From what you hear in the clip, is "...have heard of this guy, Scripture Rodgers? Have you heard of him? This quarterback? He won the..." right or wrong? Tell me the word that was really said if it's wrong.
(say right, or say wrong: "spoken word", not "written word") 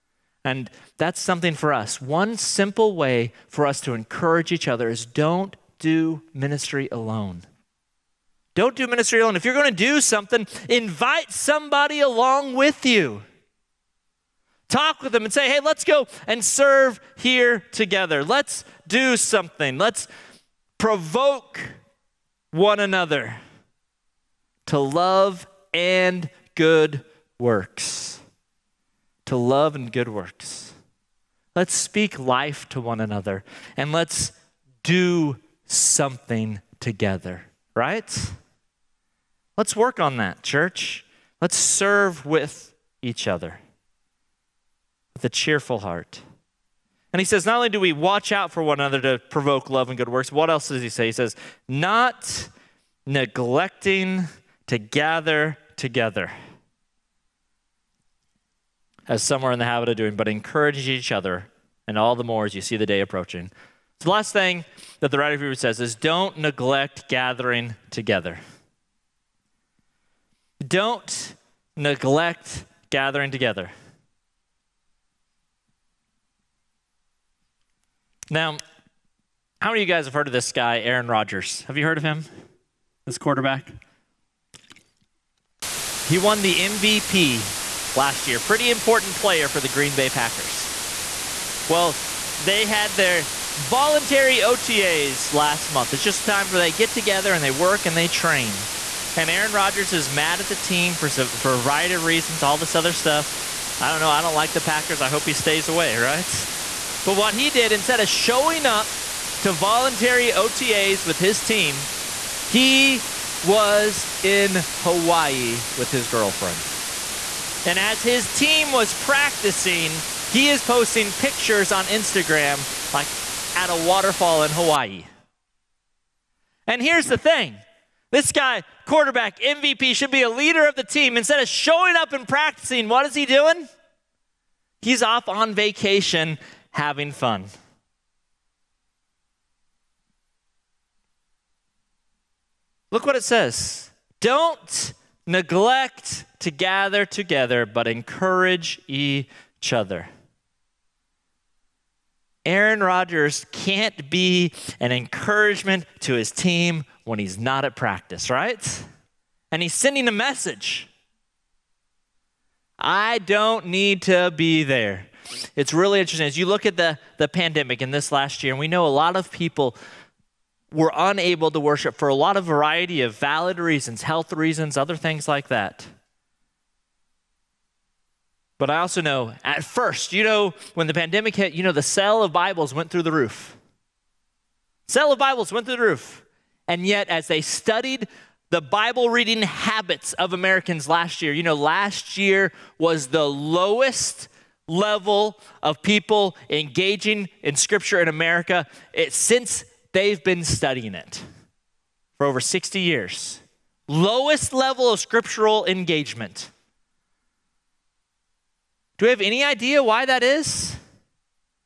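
wrong: "Aaron", not "Scripture".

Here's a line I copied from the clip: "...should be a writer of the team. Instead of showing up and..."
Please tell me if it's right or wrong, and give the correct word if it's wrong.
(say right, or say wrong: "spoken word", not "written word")
wrong: "leader", not "writer".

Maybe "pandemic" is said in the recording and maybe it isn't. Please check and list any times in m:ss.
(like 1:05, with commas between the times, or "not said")
2:47, 3:00.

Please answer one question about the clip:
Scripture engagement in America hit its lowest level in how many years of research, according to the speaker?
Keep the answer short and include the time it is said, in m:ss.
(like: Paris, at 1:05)
over 60 years, at 3:22.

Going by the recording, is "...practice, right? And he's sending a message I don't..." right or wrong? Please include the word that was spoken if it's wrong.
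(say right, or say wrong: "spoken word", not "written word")
right.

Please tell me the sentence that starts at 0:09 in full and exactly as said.
If you're going to do something, invite somebody along with you.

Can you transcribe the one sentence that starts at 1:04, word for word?
So the last thing that the writer of Hebrews says is don't neglect gathering together.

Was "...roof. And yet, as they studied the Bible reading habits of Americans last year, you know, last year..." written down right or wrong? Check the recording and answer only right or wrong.
right.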